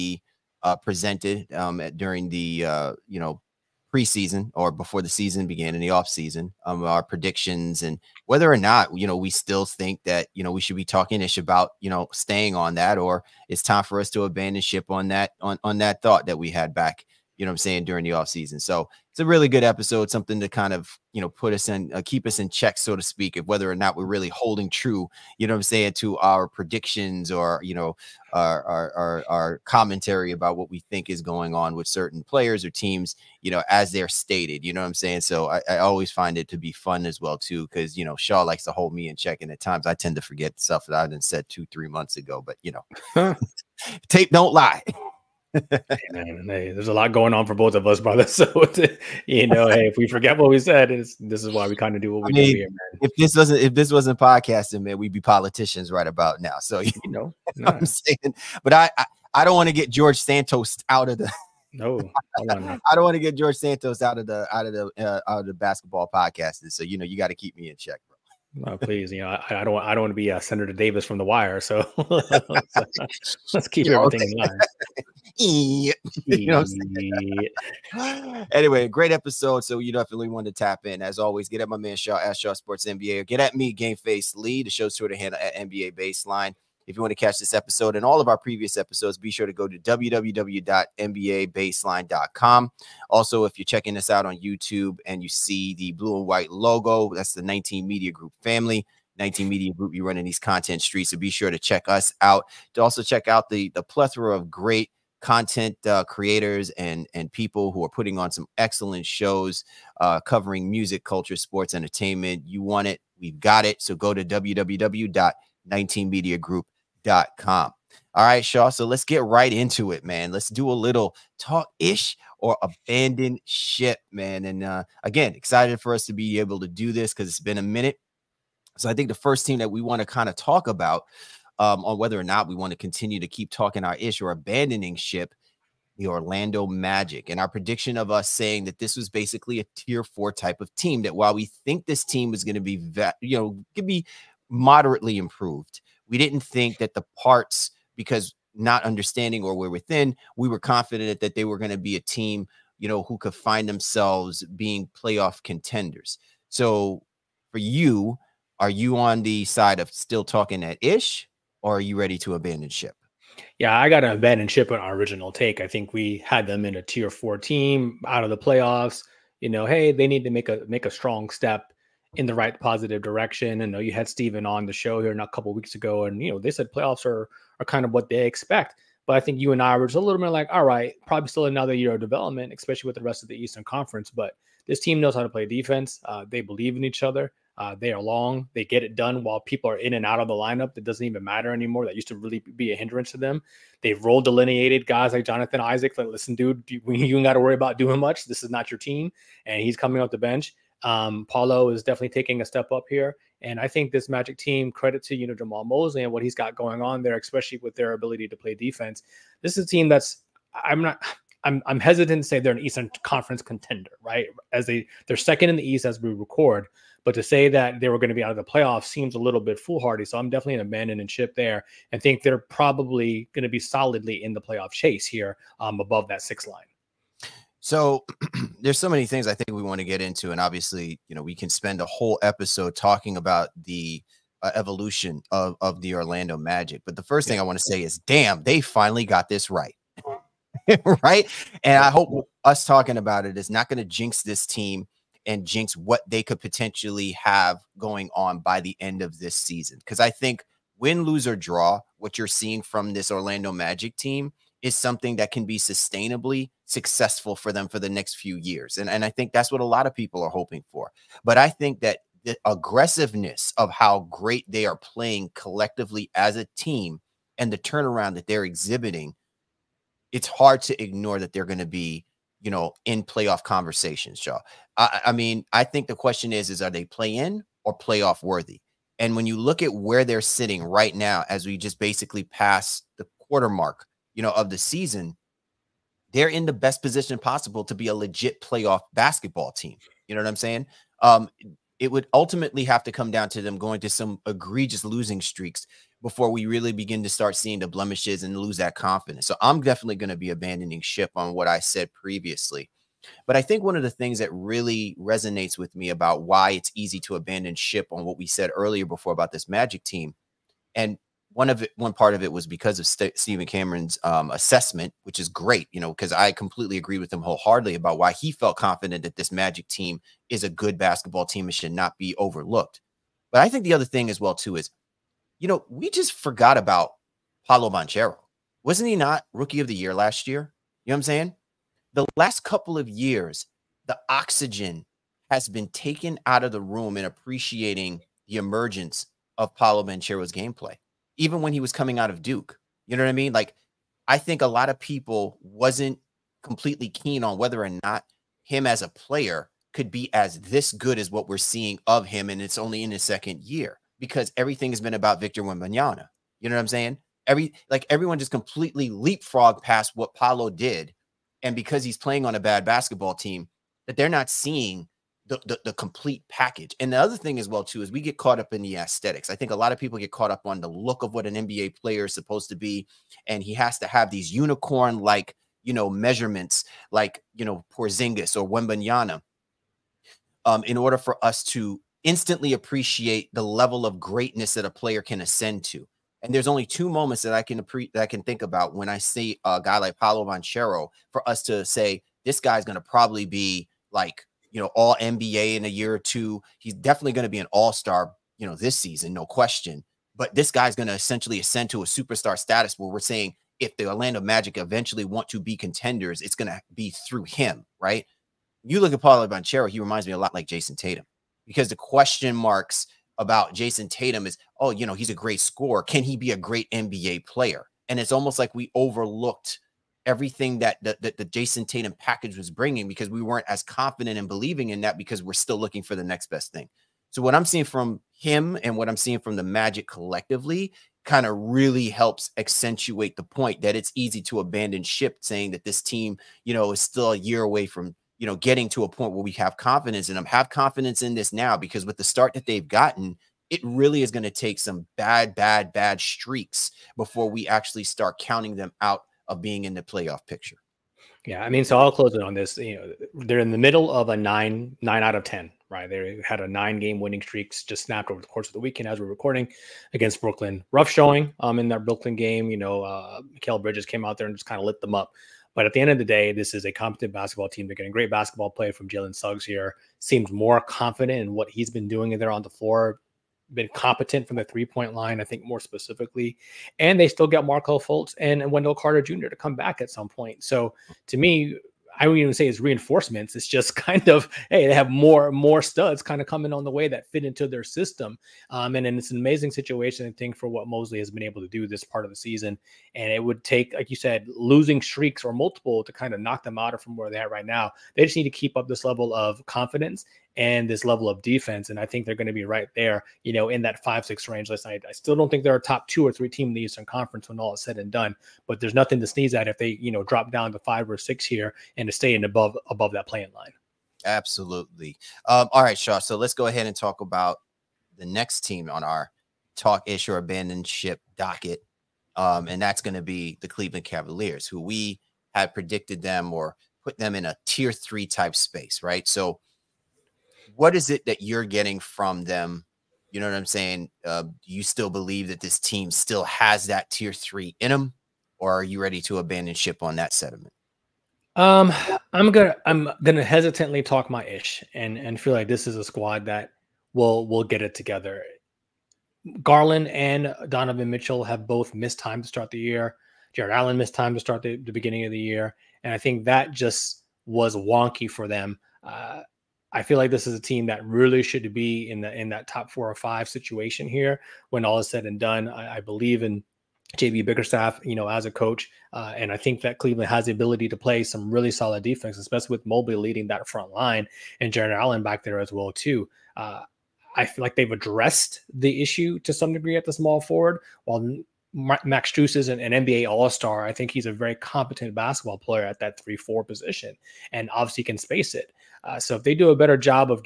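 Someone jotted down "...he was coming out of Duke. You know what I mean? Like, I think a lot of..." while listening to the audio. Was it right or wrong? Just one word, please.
right.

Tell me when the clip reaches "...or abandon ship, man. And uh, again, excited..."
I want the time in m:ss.
2:02.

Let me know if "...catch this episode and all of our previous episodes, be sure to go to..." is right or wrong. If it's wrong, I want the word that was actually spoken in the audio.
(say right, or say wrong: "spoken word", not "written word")
right.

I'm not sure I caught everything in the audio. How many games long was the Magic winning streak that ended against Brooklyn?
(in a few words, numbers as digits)
9.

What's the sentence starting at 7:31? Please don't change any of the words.
Yeah, I mean, so I'll close it on this.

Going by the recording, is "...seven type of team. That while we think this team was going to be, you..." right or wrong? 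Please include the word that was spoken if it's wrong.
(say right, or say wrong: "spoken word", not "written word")
wrong: "four", not "seven".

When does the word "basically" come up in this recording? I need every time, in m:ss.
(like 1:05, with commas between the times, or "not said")
2:19, 4:41.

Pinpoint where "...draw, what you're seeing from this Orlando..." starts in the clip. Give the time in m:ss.
4:11.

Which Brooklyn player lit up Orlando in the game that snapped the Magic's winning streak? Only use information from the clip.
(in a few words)
Mikal Bridges.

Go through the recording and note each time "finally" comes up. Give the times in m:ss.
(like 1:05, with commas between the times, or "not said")
3:58.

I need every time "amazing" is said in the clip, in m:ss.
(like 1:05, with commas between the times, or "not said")
8:09.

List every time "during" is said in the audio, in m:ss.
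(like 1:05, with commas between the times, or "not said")
0:01, 0:17.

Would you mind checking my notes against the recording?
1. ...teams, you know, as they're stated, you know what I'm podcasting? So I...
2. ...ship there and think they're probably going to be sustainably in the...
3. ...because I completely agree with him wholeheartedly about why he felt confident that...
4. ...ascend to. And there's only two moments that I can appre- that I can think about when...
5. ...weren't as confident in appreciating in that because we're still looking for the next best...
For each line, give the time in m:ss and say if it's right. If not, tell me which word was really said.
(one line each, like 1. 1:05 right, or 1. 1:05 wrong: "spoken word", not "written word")
1. 0:32 wrong: "saying", not "podcasting"
2. 3:41 wrong: "solidly", not "sustainably"
3. 5:15 right
4. 6:25 right
5. 7:03 wrong: "believing", not "appreciating".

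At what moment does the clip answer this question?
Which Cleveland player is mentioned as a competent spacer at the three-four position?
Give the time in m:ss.
9:41.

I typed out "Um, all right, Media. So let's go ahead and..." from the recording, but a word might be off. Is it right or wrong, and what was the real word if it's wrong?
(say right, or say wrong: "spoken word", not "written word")
wrong: "Shaw", not "Media".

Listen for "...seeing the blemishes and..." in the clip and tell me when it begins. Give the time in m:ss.
4:57.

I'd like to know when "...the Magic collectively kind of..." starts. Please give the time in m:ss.
7:09.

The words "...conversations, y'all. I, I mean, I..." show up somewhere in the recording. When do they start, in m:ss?
4:33.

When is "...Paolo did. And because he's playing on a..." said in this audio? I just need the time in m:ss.
6:00.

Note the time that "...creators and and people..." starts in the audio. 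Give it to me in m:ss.
1:46.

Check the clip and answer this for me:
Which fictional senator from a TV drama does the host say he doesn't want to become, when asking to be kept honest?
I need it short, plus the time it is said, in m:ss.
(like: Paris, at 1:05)
Senator Davis, at 1:10.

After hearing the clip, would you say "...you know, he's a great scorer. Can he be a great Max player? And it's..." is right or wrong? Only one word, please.
wrong.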